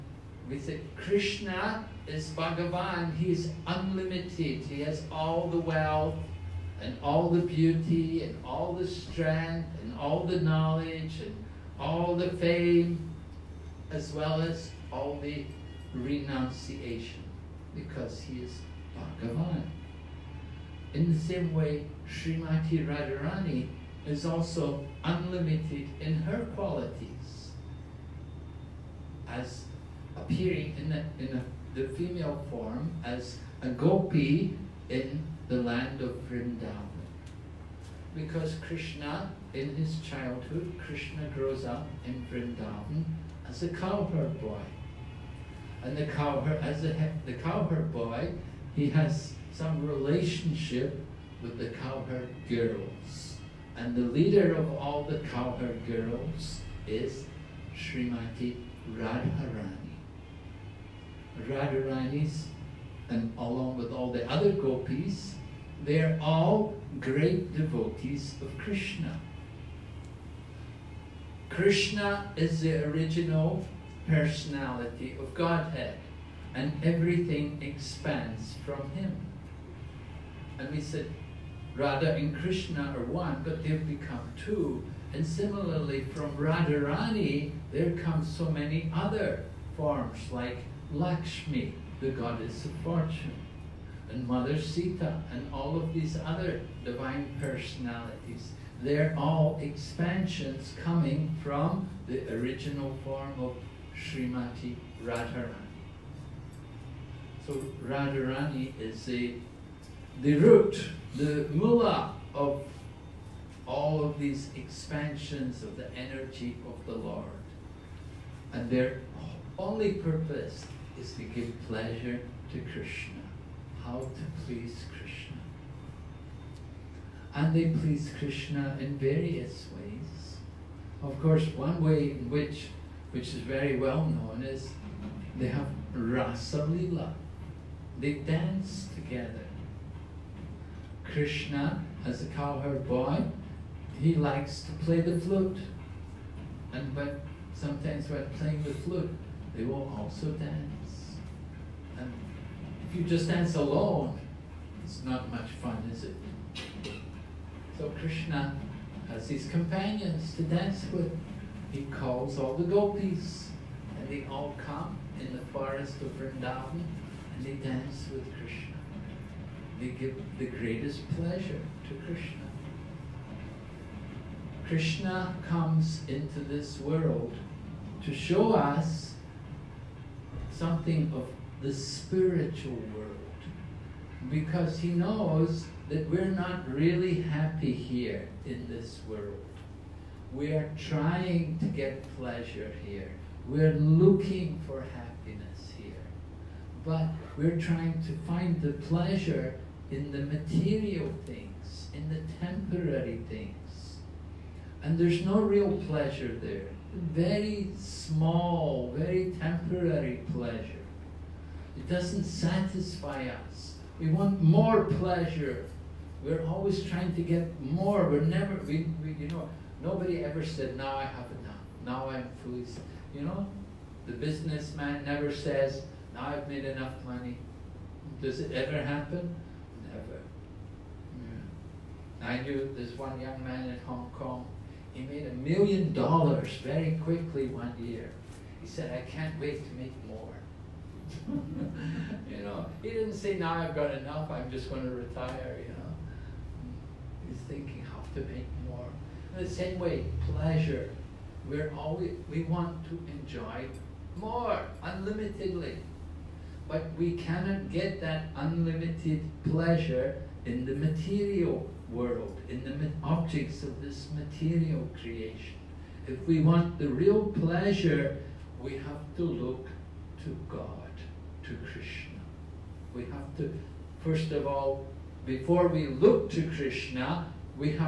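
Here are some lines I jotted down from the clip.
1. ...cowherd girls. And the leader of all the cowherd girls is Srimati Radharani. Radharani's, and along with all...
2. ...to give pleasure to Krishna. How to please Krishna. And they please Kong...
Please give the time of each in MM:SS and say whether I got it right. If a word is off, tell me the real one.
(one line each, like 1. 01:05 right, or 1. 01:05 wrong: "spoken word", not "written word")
1. 00:51 right
2. 02:01 wrong: "Krishna", not "Kong".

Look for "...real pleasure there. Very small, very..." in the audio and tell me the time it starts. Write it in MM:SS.
03:25.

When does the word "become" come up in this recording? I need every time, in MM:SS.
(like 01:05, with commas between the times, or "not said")
01:23.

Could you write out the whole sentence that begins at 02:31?
And if you just dance alone, it's not much fun, is it?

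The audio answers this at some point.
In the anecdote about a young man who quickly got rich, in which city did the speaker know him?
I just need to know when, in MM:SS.
03:53.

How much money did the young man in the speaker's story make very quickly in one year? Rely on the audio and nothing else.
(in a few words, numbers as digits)
$1,000,000.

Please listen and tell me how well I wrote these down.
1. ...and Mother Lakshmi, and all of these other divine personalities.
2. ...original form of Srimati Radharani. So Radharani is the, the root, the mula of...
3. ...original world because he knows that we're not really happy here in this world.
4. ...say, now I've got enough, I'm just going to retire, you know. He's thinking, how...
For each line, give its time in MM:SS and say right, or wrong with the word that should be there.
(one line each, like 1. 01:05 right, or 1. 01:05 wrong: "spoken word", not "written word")
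1. 01:34 wrong: "Sita", not "Lakshmi"
2. 01:42 right
3. 03:01 wrong: "spiritual", not "original"
4. 04:03 right.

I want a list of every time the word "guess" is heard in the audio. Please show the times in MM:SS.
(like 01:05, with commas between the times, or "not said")
not said.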